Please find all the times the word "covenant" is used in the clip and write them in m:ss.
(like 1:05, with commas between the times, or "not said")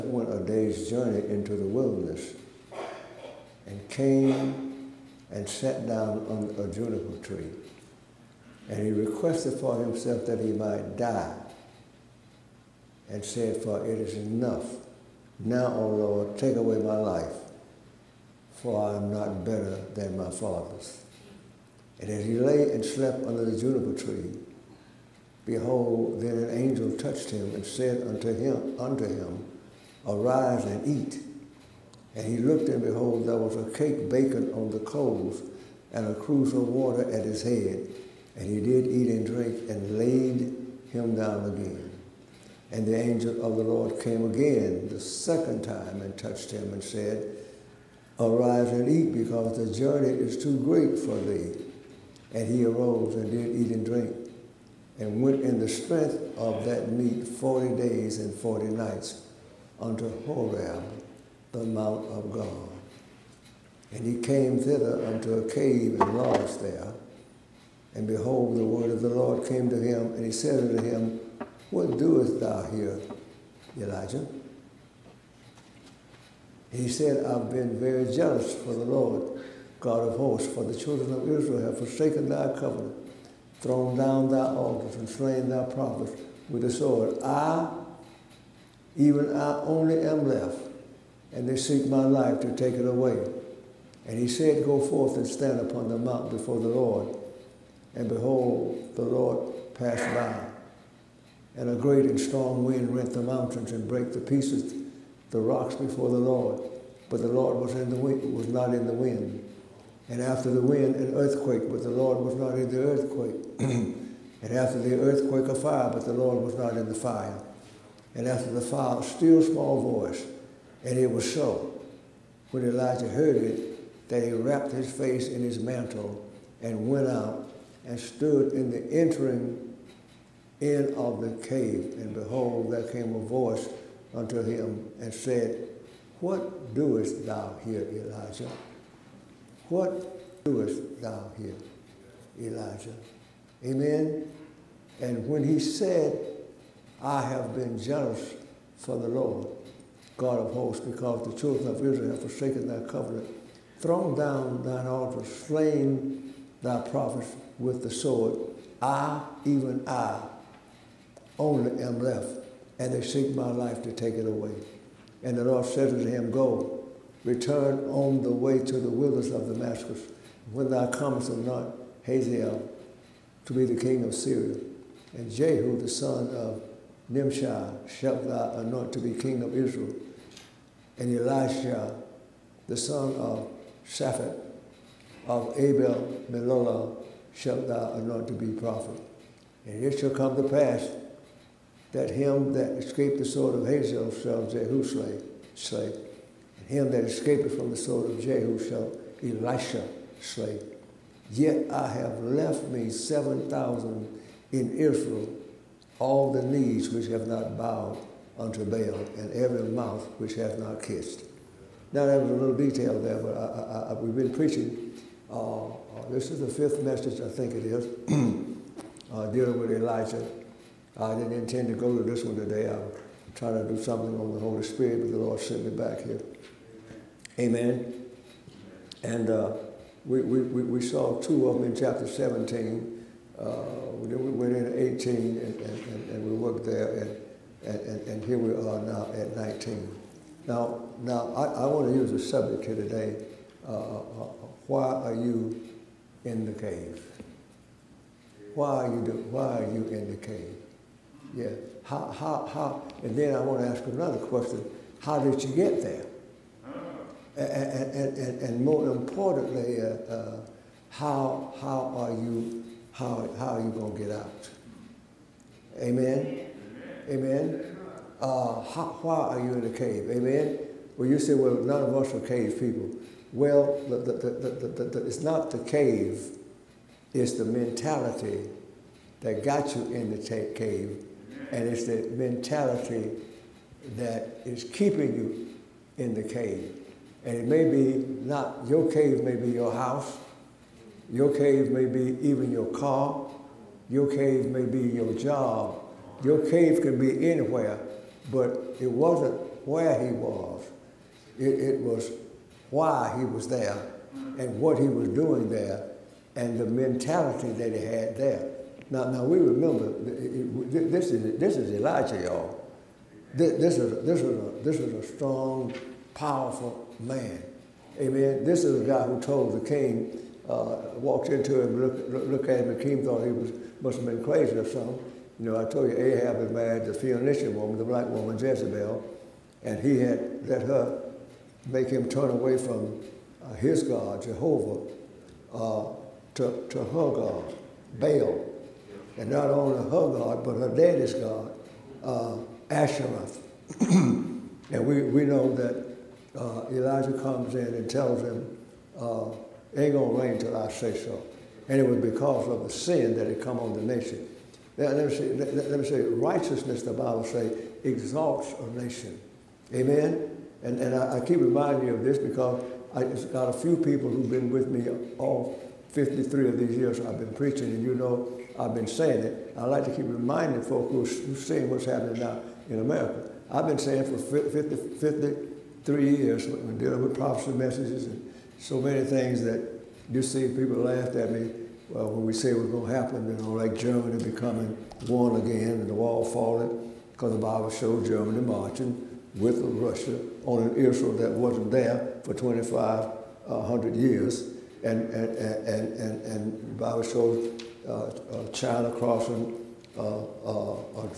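1:22, 2:32.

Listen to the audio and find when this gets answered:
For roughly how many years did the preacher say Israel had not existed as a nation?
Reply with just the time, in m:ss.
6:32.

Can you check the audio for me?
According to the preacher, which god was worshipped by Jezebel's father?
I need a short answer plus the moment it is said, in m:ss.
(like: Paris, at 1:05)
Asherah, at 5:42.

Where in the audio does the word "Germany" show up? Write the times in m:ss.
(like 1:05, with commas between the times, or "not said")
6:23, 6:28.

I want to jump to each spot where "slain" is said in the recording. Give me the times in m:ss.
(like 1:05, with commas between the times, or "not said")
1:25, 2:35.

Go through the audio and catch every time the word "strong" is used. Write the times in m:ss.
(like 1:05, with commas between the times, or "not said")
1:42, 5:15.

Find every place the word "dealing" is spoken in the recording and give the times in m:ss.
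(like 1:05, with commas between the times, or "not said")
3:39, 6:16.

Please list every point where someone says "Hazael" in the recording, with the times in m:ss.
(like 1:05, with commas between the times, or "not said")
2:52, 3:13.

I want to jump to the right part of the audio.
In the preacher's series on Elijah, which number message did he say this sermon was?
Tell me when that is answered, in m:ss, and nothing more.
3:36.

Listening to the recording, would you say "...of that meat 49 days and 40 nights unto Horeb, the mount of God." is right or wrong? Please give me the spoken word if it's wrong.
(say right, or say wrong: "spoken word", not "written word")
wrong: "40", not "49".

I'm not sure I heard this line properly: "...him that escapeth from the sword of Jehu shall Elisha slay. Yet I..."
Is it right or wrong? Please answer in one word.
right.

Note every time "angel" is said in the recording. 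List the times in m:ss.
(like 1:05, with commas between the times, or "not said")
0:26, 0:42.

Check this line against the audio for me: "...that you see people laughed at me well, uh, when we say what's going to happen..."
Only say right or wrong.
right.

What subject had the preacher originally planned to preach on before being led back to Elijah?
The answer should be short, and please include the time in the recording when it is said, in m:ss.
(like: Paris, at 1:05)
the Holy Spirit, at 3:44.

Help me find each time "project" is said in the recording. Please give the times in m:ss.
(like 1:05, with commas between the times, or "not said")
not said.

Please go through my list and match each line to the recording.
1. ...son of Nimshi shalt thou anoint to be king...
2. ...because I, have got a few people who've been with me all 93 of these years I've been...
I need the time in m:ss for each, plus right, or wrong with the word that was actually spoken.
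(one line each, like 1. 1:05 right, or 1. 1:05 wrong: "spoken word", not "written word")
1. 2:55 right
2. 6:02 wrong: "53", not "93".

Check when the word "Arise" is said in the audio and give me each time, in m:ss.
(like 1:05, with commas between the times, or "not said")
0:30, 0:48.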